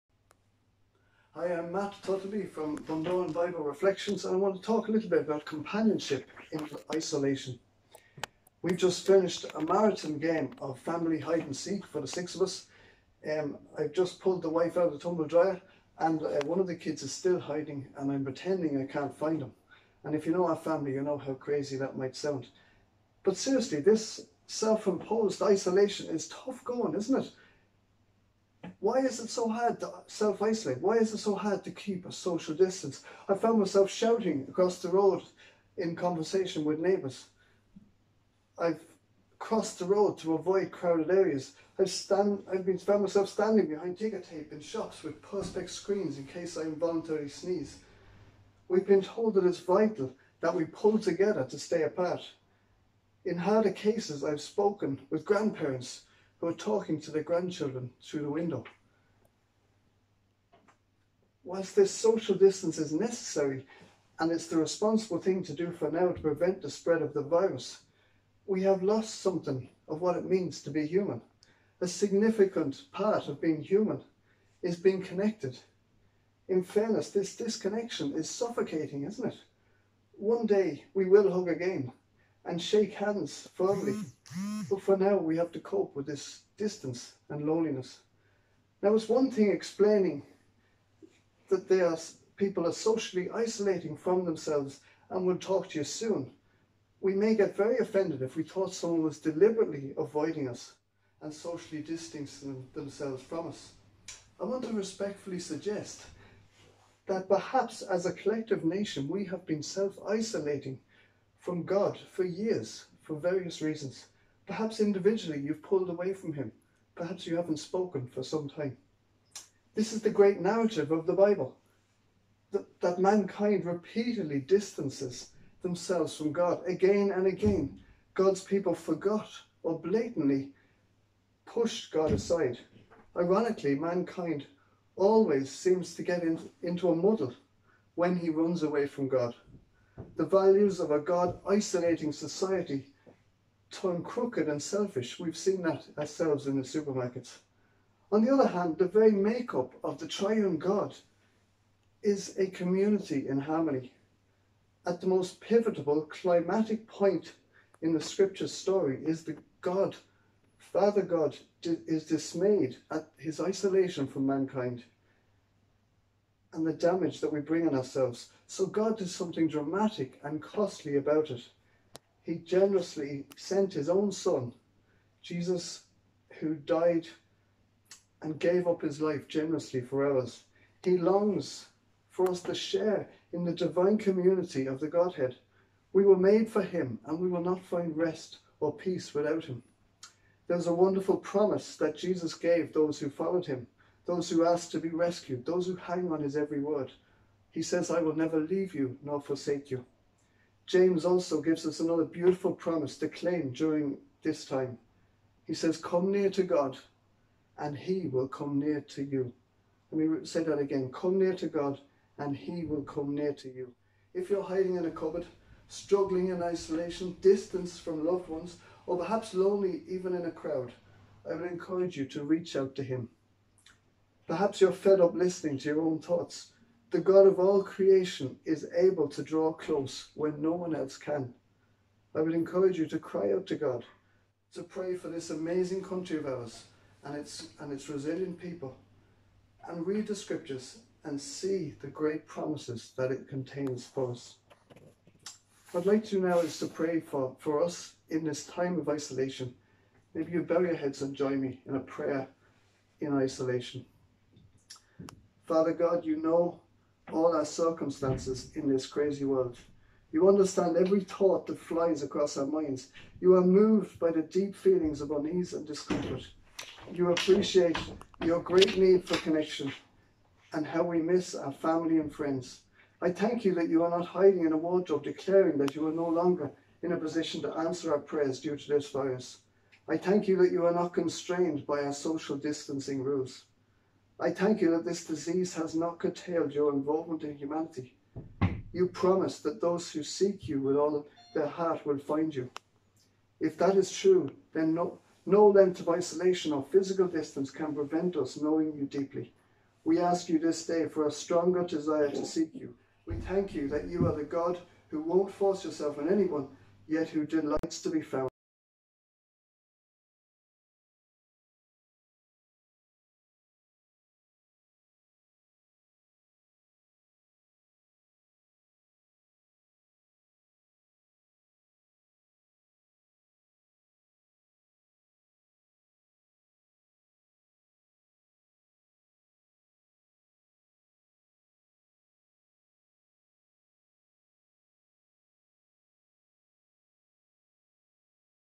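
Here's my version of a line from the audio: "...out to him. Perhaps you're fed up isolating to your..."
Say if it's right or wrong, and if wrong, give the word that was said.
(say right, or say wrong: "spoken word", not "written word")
wrong: "listening", not "isolating".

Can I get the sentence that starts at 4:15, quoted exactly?
Father God, you know all our circumstances in this crazy world.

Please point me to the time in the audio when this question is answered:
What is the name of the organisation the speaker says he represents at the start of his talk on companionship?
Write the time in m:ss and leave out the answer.
0:02.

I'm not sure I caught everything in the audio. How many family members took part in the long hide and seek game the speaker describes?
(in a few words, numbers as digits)
6.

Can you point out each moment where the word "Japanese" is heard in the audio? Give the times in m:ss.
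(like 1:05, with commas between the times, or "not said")
not said.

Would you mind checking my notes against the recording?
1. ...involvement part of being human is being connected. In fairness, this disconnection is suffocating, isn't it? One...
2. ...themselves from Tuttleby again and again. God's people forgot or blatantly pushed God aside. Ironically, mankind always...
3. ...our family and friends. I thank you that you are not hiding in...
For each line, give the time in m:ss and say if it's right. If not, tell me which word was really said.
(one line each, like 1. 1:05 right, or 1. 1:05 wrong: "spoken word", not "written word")
1. 1:11 wrong: "significant", not "involvement"
2. 2:05 wrong: "God", not "Tuttleby"
3. 4:31 right.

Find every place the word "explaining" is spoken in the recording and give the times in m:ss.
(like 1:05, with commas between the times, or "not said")
1:29.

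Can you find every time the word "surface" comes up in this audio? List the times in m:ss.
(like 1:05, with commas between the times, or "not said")
not said.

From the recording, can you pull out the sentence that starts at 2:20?
The values of a God isolating society turn crooked and selfish.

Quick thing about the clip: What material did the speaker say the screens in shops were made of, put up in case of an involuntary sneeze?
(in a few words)
perspex.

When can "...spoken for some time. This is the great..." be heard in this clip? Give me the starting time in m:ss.
1:57.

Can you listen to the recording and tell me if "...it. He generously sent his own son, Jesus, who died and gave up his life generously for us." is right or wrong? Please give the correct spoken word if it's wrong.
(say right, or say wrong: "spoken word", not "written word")
right.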